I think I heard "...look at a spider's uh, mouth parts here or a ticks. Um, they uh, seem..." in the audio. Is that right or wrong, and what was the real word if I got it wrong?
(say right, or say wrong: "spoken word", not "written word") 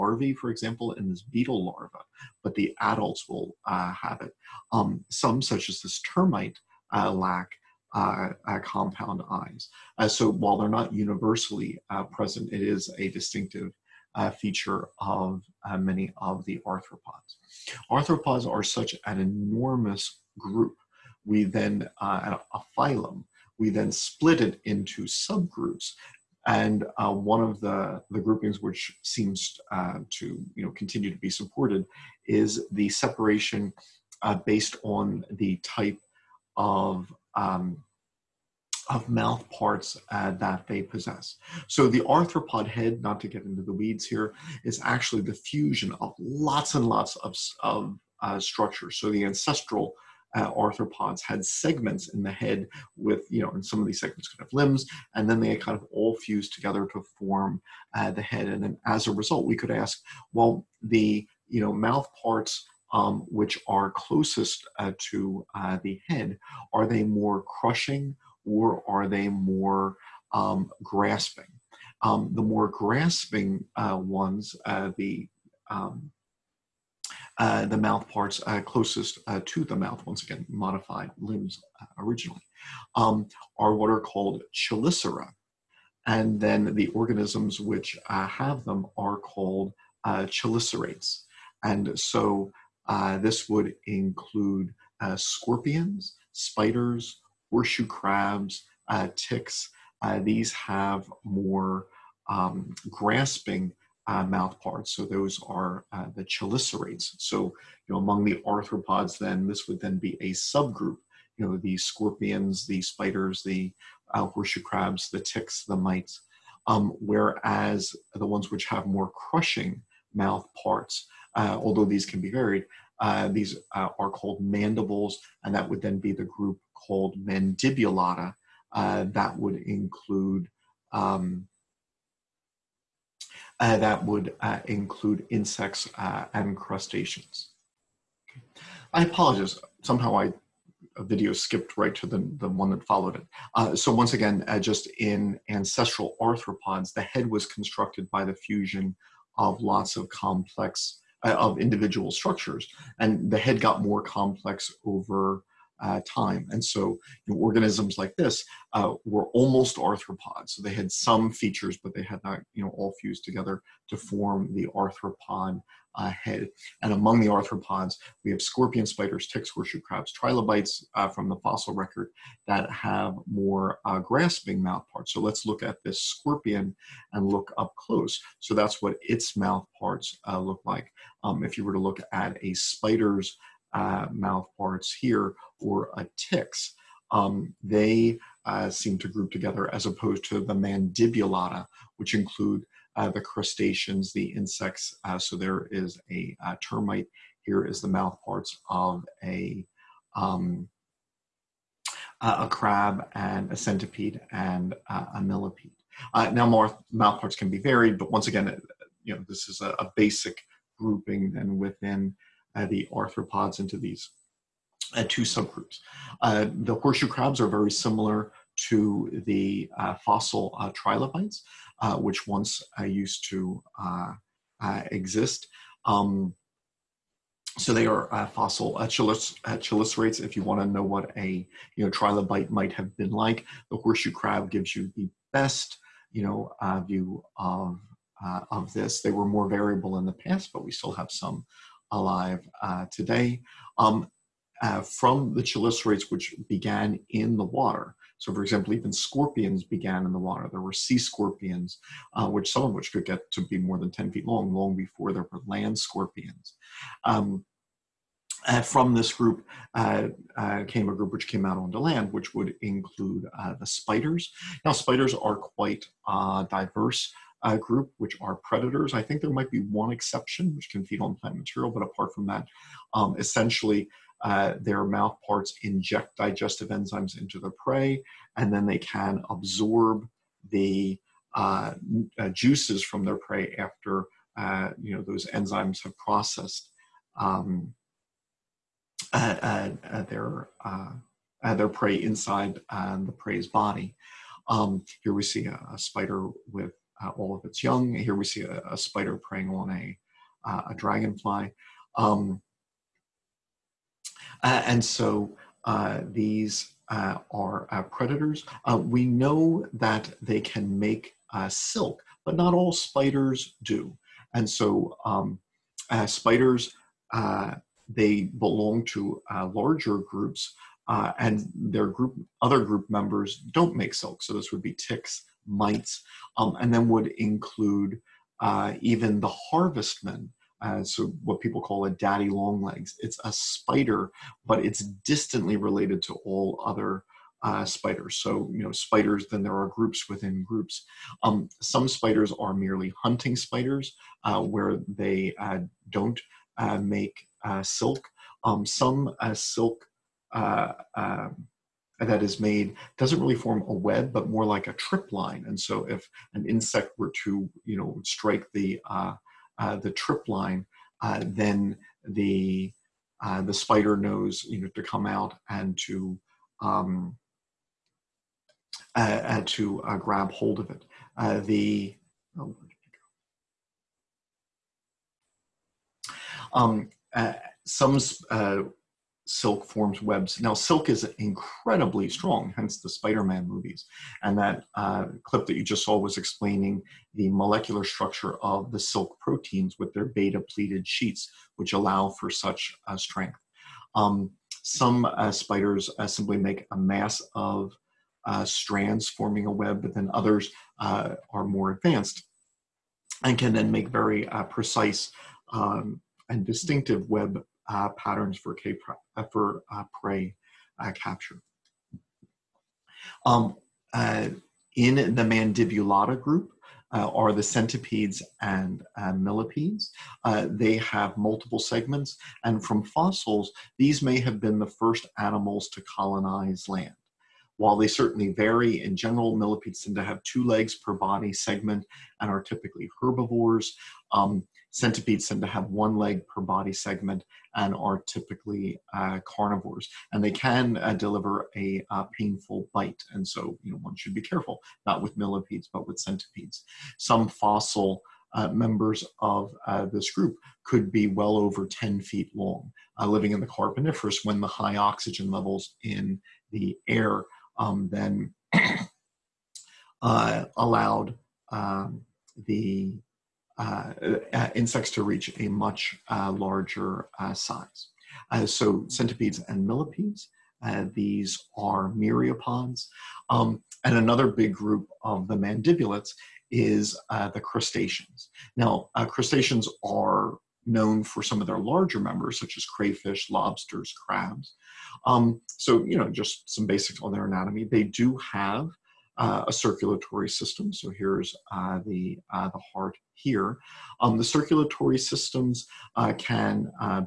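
right.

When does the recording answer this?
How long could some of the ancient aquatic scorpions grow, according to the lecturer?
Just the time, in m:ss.
4:13.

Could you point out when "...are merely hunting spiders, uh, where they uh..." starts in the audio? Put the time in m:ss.
5:42.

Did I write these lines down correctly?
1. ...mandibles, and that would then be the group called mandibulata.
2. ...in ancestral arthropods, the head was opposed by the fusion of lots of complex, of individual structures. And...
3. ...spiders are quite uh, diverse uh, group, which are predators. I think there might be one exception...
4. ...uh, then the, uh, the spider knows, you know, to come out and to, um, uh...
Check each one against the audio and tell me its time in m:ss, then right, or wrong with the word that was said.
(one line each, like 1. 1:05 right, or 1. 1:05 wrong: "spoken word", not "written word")
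1. 2:04 right
2. 2:24 wrong: "constructed", not "opposed"
3. 4:24 right
4. 6:01 right.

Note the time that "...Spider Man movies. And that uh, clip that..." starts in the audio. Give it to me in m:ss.
6:22.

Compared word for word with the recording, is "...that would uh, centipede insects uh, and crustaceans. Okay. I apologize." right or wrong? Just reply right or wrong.
wrong.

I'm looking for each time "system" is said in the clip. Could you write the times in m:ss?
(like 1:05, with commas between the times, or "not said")
8:10, 8:14.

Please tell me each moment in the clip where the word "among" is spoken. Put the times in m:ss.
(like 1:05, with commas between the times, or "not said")
1:47, 2:46.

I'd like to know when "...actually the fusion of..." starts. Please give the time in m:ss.
0:44.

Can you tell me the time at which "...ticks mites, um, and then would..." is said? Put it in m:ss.
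5:24.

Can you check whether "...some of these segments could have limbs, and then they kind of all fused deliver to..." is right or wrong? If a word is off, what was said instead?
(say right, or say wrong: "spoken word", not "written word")
wrong: "together", not "deliver".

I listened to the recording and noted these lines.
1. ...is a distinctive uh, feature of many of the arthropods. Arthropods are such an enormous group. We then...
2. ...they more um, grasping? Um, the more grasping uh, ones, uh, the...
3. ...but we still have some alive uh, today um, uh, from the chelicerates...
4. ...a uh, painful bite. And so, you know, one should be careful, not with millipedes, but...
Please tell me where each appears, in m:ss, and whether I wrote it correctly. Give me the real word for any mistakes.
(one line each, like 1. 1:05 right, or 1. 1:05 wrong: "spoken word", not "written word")
1. 0:12 right
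2. 1:09 right
3. 4:00 right
4. 7:21 right.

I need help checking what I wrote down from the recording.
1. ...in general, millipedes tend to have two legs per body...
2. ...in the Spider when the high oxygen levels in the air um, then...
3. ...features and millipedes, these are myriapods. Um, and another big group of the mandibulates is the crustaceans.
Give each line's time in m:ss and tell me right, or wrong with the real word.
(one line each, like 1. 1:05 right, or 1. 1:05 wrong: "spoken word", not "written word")
1. 7:08 right
2. 7:33 wrong: "Carboniferous", not "Spider"
3. 7:48 wrong: "centipedes", not "features".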